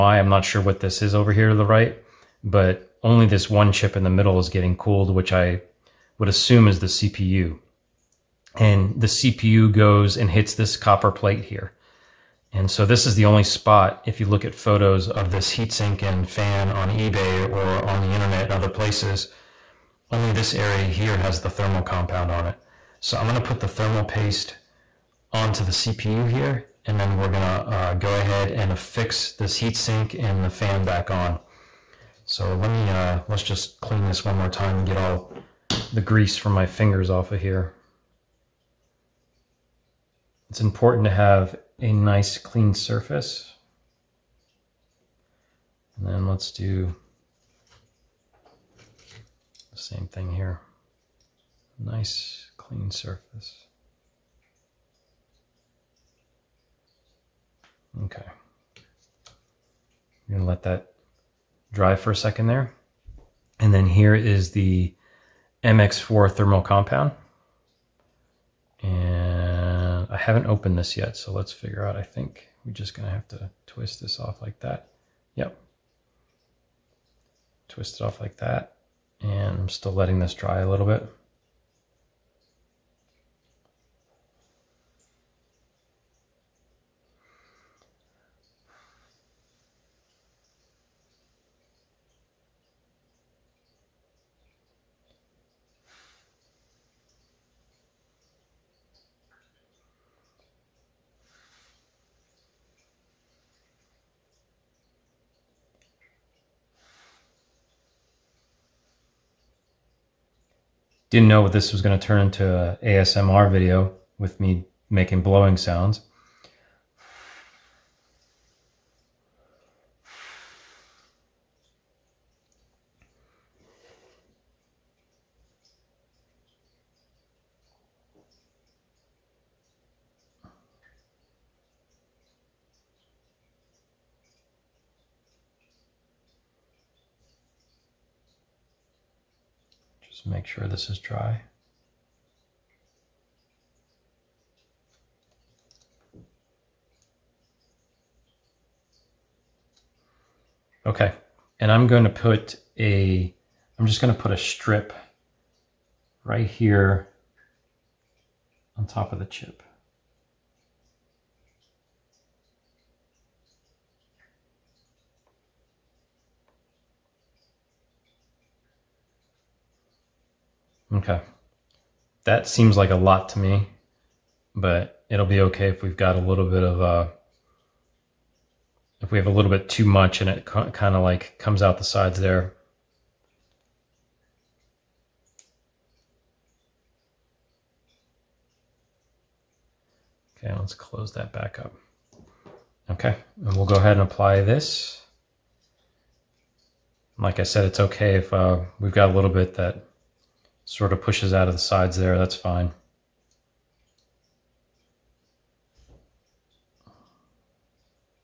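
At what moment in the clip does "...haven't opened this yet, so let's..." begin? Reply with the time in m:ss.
1:10.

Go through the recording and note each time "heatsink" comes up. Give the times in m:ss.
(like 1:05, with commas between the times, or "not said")
0:15, 0:29.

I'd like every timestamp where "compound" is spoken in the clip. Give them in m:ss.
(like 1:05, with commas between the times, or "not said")
0:21, 1:06.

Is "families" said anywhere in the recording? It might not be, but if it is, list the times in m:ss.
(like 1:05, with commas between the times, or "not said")
not said.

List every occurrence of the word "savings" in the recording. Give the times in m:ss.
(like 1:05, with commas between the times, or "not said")
not said.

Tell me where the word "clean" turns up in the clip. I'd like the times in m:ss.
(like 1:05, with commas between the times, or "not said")
0:33, 0:42, 0:52.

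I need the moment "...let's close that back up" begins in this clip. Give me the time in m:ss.
3:10.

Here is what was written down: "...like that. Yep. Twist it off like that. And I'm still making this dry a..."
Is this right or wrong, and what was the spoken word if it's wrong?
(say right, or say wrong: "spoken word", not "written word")
wrong: "letting", not "making".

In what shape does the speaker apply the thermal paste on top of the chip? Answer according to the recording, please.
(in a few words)
A strip.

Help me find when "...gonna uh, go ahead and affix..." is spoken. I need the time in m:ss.
0:27.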